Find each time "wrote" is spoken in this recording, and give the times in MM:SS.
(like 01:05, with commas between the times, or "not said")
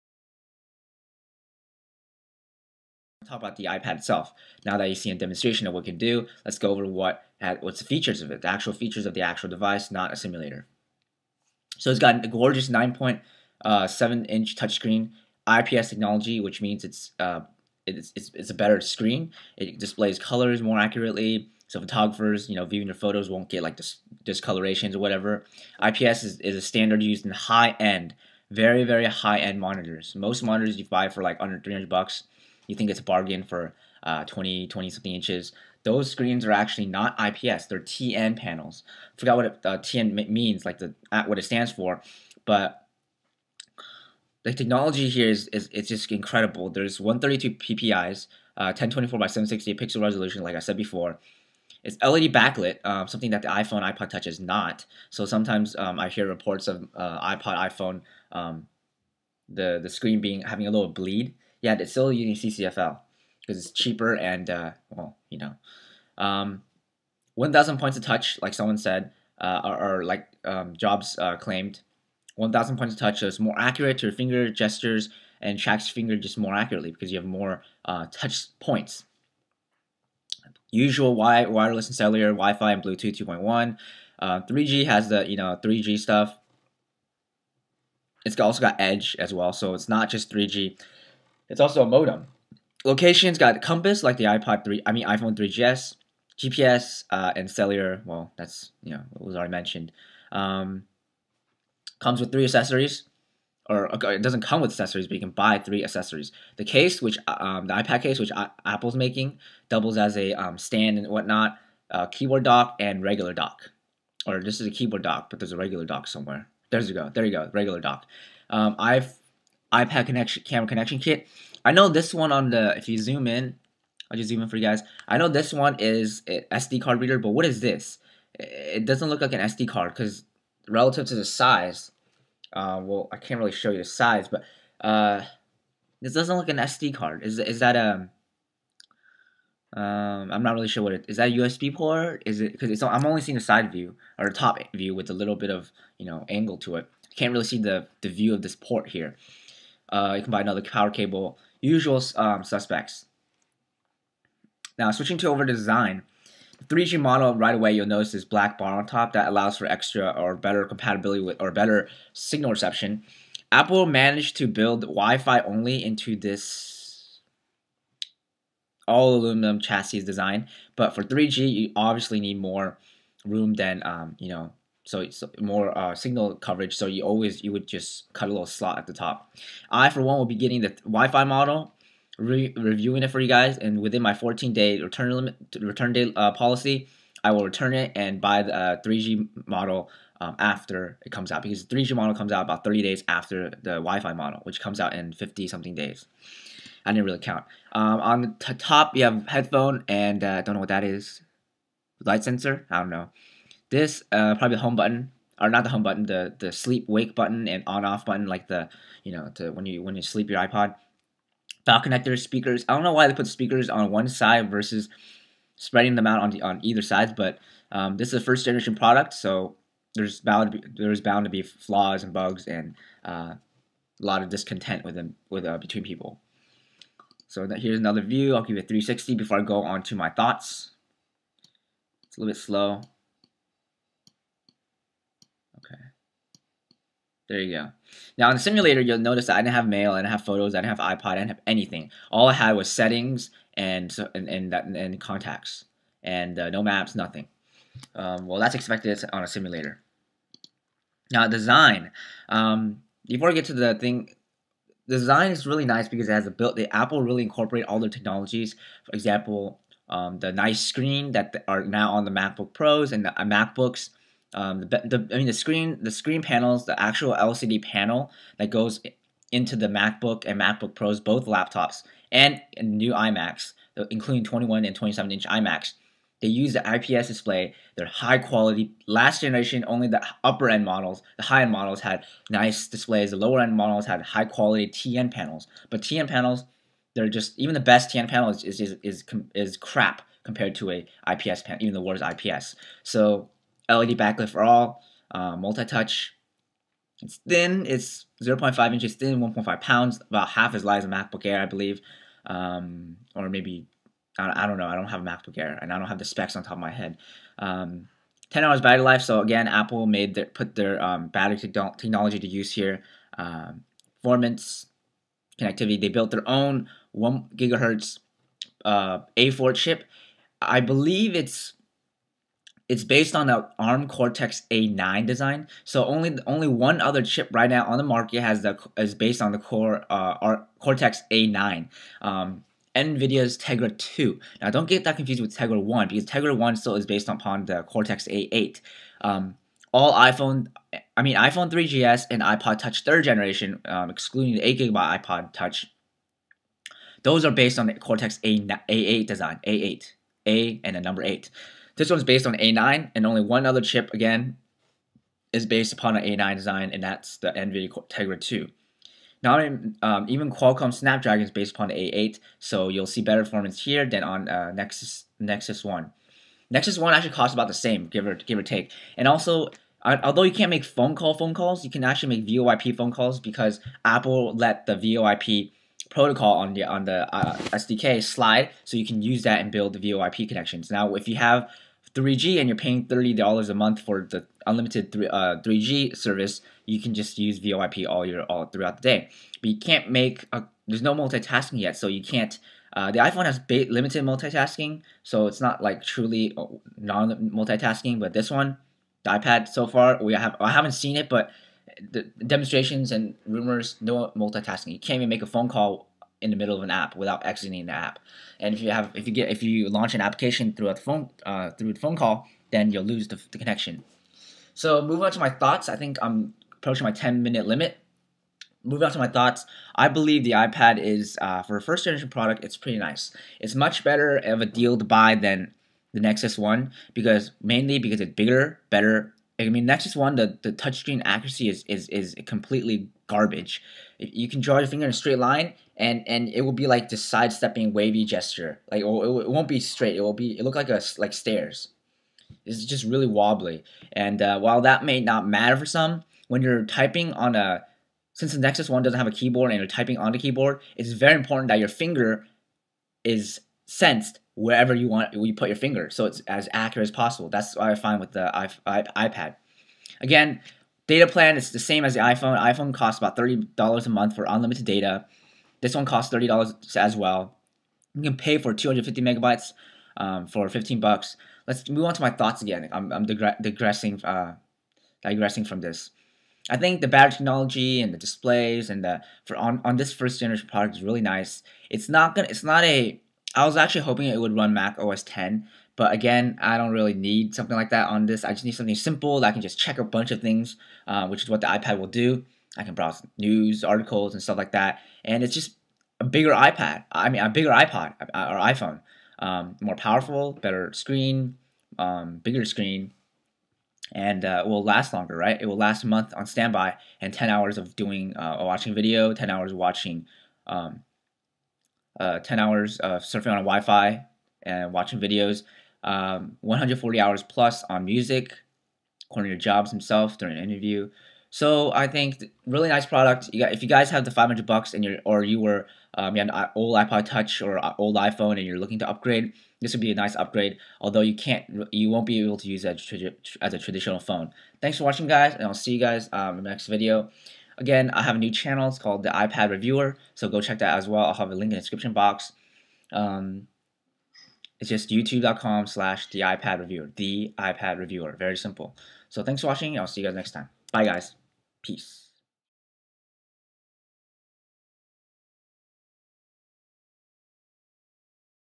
not said.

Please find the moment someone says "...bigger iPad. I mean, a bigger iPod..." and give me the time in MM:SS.
08:16.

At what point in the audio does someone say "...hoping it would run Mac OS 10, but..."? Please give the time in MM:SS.
08:03.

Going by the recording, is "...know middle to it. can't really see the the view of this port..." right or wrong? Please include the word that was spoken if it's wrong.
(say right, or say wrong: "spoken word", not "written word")
wrong: "angle", not "middle".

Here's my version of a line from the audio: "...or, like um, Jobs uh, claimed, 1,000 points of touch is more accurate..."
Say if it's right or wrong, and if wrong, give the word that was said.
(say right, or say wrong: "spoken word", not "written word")
right.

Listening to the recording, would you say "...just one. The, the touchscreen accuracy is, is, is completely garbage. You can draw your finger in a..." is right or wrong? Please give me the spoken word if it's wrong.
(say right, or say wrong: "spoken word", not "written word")
right.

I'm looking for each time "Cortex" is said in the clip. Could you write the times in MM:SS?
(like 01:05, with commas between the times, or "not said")
05:23, 05:30, 05:37, 05:47.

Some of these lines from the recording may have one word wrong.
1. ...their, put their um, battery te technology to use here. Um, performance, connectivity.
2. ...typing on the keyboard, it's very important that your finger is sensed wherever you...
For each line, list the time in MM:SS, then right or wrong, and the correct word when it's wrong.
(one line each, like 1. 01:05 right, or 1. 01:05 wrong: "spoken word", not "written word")
1. 05:10 right
2. 07:29 right.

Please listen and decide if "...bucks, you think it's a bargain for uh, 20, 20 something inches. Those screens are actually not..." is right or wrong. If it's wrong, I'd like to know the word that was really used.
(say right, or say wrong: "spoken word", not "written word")
right.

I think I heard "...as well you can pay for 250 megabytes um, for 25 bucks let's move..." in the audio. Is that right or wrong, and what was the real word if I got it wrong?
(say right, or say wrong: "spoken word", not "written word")
wrong: "15", not "25".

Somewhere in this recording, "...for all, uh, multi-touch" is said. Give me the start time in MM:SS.
04:54.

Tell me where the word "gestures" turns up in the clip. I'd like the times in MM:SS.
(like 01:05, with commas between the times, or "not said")
01:14, 07:18.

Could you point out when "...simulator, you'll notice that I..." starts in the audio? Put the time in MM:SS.
03:58.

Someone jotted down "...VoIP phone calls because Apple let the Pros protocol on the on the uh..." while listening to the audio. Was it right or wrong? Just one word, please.
wrong.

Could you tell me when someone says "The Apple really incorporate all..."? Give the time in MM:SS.
04:16.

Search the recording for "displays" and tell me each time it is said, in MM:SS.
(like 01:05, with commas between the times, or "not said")
00:19, 04:37, 04:42, 07:57.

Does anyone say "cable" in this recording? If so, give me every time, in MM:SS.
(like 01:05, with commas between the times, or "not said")
02:30.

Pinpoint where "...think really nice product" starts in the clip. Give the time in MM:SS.
08:41.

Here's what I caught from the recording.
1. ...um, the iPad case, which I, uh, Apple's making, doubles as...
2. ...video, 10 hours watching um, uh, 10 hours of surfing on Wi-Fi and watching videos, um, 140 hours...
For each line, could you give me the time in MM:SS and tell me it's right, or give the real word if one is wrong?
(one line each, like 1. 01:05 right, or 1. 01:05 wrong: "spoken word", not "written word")
1. 01:47 right
2. 08:28 right.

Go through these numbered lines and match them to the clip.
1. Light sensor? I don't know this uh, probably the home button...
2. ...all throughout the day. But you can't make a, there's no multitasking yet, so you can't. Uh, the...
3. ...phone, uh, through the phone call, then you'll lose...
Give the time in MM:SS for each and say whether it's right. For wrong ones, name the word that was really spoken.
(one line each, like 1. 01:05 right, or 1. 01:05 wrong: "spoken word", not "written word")
1. 03:22 right
2. 06:28 right
3. 06:50 right.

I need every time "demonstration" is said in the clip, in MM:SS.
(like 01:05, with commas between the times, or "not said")
00:05, 06:42.